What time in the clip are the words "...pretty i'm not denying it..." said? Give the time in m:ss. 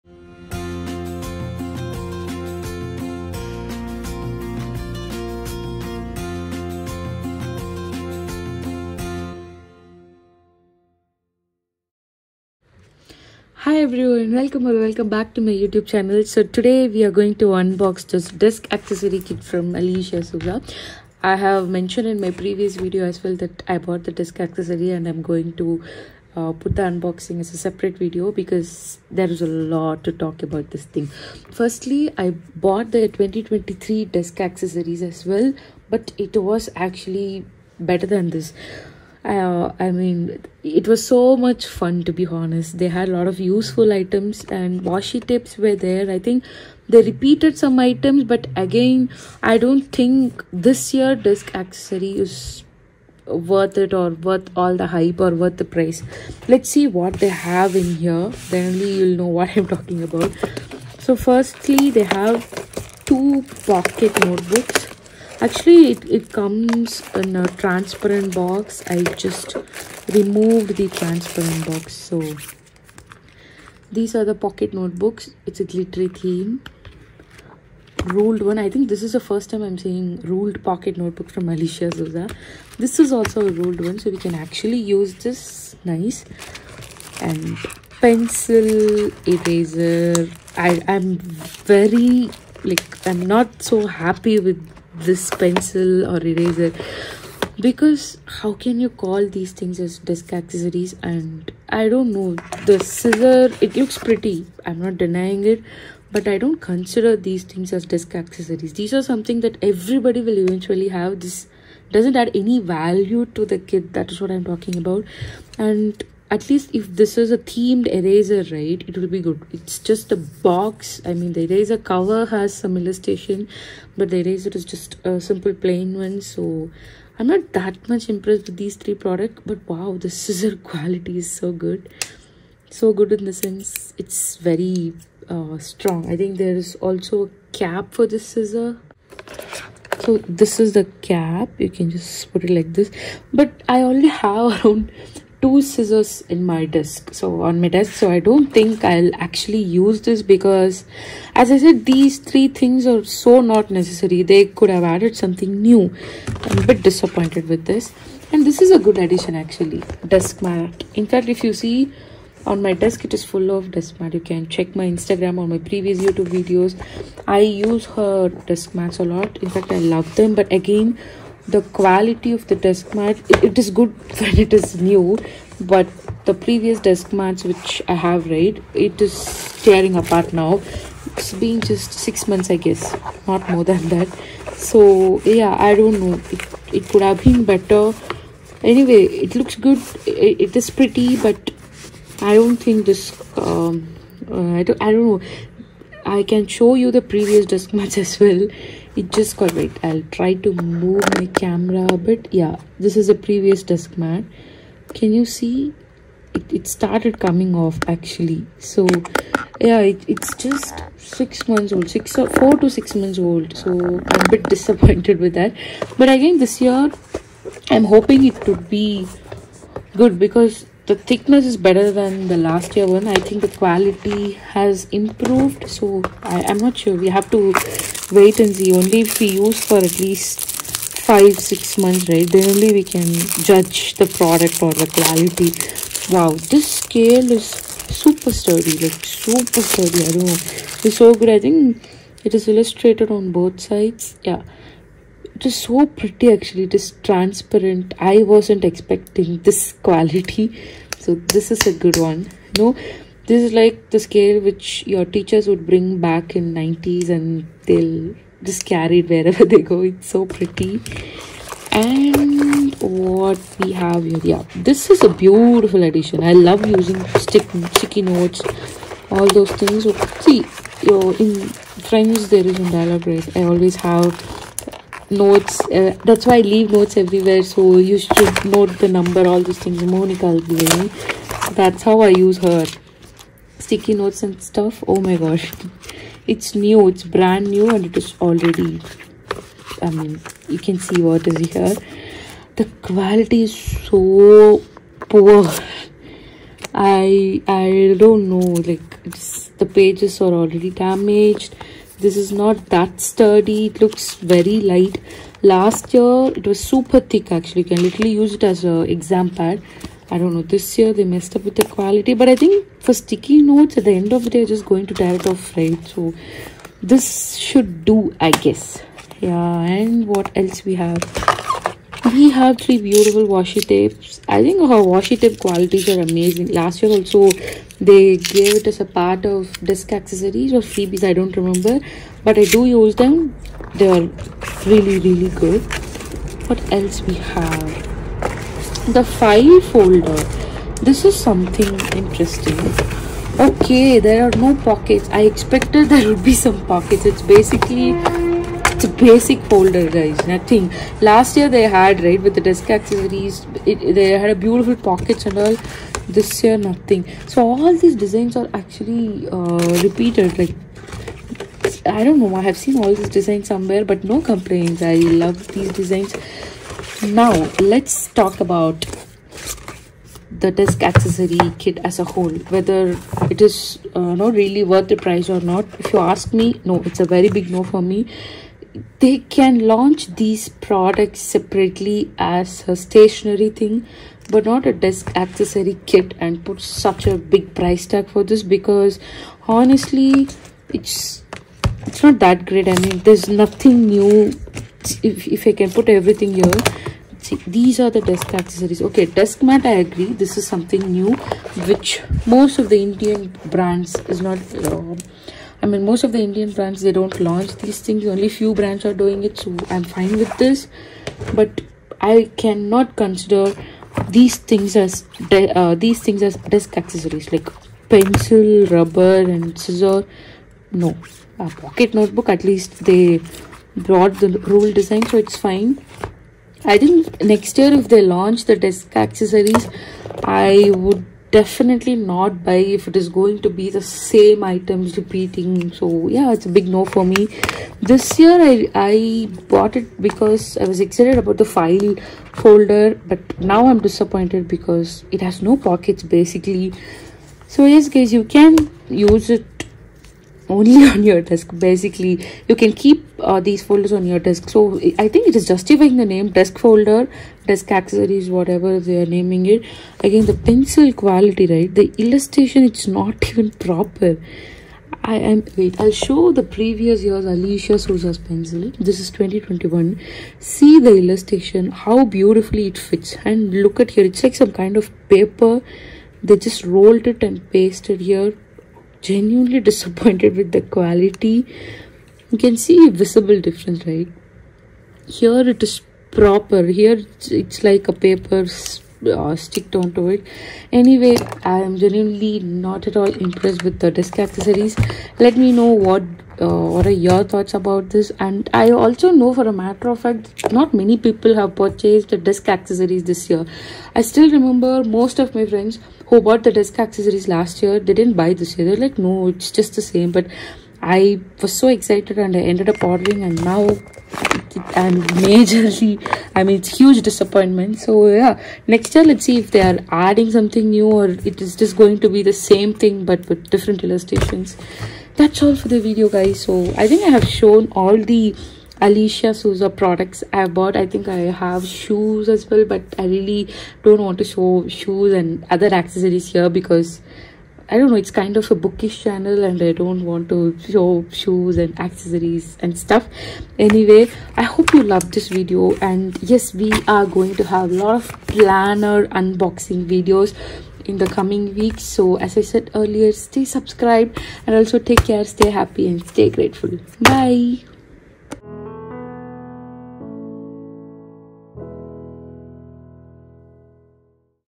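1:43.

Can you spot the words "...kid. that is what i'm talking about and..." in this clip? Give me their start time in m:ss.
1:53.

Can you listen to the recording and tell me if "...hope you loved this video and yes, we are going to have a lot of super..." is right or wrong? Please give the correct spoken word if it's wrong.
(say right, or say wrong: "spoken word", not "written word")
wrong: "planner", not "super".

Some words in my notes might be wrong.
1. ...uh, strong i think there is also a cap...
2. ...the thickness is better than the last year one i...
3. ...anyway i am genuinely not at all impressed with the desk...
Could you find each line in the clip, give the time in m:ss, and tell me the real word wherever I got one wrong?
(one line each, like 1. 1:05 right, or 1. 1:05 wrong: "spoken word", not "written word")
1. 2:15 right
2. 3:40 right
3. 8:10 right.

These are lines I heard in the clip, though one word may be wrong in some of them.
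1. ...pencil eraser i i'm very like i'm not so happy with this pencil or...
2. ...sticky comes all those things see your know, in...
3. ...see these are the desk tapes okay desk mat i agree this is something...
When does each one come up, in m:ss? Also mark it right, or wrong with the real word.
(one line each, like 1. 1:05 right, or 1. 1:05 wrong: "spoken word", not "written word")
1. 1:27 right
2. 4:27 wrong: "notes", not "comes"
3. 6:37 wrong: "accessories", not "tapes".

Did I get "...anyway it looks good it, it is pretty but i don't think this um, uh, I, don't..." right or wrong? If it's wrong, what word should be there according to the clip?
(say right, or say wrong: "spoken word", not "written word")
right.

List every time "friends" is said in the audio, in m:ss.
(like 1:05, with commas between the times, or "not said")
4:31, 8:25.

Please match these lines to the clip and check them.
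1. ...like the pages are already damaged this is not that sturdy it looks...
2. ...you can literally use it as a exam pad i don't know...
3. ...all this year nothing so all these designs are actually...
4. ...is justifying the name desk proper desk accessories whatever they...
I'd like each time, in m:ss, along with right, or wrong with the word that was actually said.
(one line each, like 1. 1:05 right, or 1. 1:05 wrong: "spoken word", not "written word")
1. 4:58 right
2. 5:07 right
3. 5:55 right
4. 7:35 wrong: "folder", not "proper".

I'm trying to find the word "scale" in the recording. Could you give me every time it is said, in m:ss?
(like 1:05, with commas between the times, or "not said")
3:56, 4:13.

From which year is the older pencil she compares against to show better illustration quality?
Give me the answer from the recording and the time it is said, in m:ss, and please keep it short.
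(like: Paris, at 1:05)
2021, at 7:49.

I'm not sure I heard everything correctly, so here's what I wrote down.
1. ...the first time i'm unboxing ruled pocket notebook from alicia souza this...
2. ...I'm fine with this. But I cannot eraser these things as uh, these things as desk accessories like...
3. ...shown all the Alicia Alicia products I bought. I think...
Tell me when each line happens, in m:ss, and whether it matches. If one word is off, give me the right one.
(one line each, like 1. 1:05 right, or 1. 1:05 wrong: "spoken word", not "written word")
1. 1:19 wrong: "seeing", not "unboxing"
2. 6:49 wrong: "consider", not "eraser"
3. 8:47 wrong: "Souza", not "Alicia".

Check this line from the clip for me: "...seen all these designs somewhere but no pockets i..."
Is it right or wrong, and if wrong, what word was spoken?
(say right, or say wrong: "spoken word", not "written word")
wrong: "complaints", not "pockets".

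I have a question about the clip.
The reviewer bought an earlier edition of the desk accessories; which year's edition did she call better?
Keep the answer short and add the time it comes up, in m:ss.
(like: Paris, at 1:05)
2023, at 0:33.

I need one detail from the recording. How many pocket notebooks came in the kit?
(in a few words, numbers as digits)
2.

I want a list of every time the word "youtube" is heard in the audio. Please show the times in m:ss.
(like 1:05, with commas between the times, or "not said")
0:15, 2:46.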